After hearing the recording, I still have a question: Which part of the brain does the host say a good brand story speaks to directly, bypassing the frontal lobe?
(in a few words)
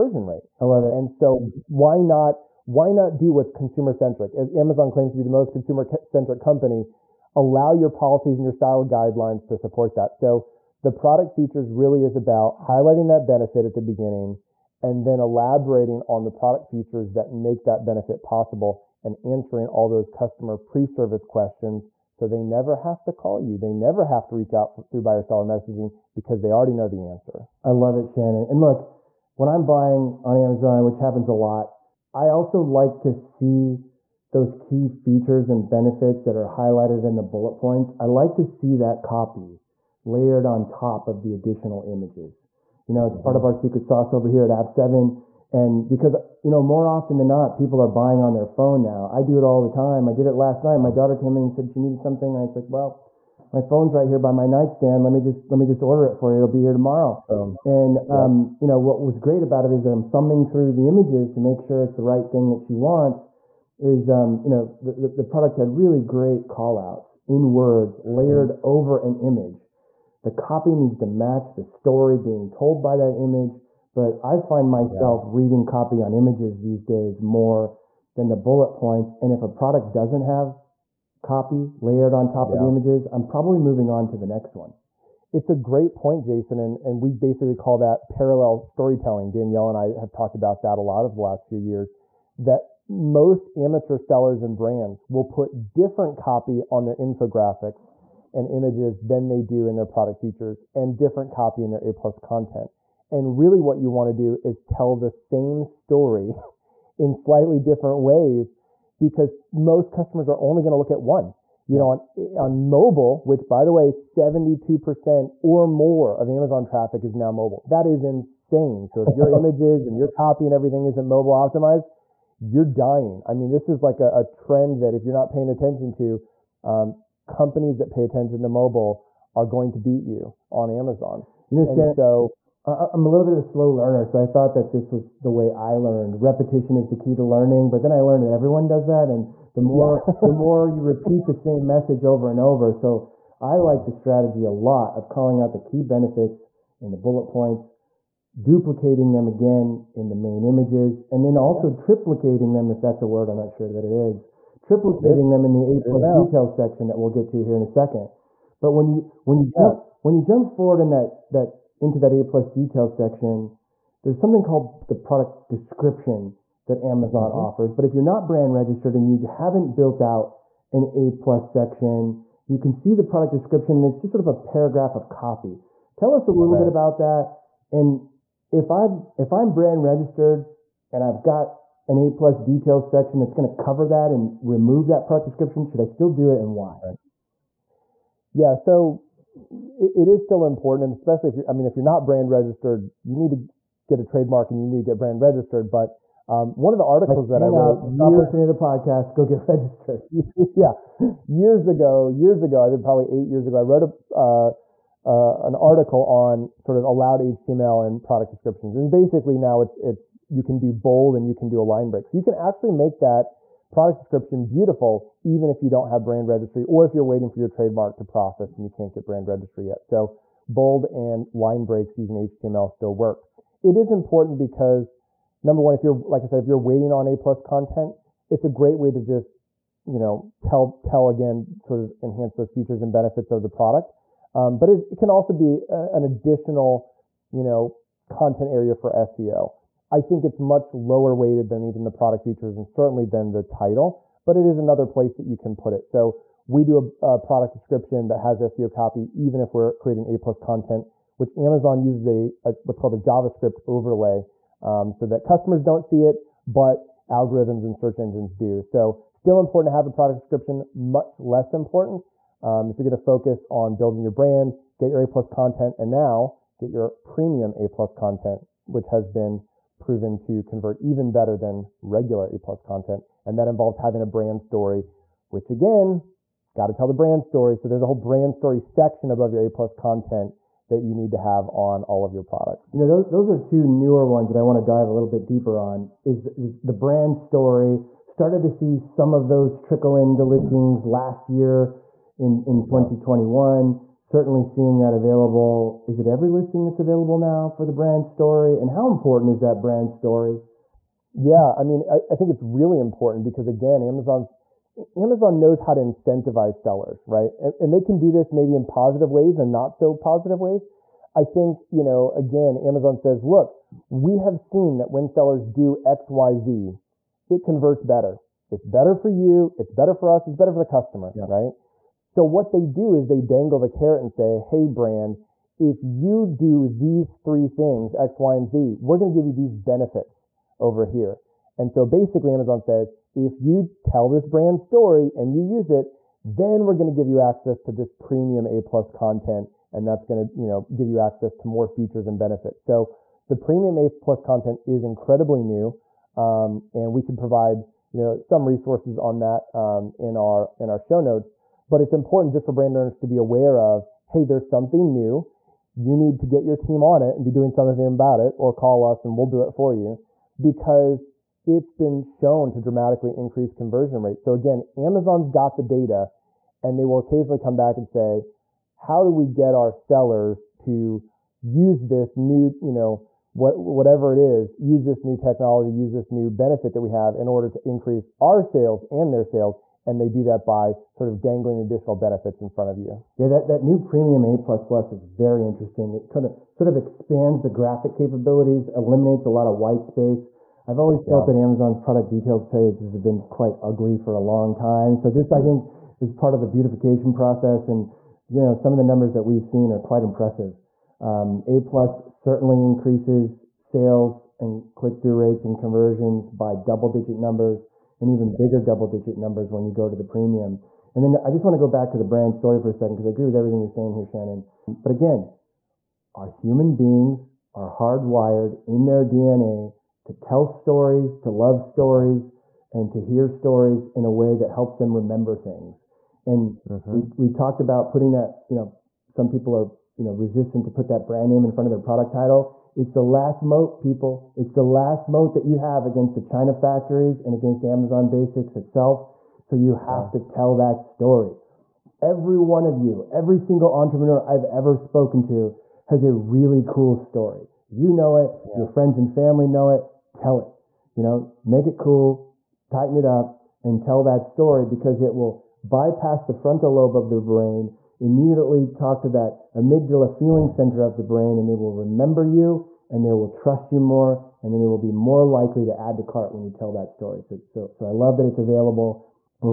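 amygdala.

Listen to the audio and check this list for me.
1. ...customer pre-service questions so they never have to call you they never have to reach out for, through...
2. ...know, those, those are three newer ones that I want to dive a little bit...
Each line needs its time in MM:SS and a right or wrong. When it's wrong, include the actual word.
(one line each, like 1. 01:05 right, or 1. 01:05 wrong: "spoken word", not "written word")
1. 00:20 right
2. 04:42 wrong: "two", not "three".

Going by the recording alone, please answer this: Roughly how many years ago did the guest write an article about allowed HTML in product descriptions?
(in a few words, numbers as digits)
8 years.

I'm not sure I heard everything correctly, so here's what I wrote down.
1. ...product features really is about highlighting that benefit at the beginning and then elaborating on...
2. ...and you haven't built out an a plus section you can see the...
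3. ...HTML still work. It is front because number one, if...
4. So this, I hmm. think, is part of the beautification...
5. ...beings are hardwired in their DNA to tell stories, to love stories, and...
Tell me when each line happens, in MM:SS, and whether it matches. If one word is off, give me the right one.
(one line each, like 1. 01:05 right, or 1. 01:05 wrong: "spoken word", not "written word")
1. 00:10 right
2. 02:48 right
3. 03:42 wrong: "important", not "front"
4. 06:34 right
5. 06:56 right.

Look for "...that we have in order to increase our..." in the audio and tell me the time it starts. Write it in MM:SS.
06:16.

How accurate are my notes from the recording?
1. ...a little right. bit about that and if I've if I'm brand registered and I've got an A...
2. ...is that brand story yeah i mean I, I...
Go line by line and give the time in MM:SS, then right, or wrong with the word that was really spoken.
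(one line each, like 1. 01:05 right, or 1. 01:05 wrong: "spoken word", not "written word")
1. 02:56 right
2. 04:59 right.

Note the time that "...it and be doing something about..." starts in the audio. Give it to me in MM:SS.
05:57.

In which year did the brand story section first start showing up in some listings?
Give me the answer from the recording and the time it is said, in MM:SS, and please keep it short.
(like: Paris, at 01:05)
2021, at 04:52.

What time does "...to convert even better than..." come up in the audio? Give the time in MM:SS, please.
04:30.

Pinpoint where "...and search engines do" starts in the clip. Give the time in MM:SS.
04:17.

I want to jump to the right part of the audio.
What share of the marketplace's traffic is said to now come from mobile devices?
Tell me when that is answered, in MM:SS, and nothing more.
01:53.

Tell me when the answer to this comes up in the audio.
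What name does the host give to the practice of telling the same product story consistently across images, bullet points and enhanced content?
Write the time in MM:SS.
01:28.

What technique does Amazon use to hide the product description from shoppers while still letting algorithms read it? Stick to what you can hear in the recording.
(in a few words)
JavaScript overlay.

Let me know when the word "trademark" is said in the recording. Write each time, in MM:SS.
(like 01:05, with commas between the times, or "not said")
03:14, 03:37.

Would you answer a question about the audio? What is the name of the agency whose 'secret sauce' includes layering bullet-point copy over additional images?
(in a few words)
AV7.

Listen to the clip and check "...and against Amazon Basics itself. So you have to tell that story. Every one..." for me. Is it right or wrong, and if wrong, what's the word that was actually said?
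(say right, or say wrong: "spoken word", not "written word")
right.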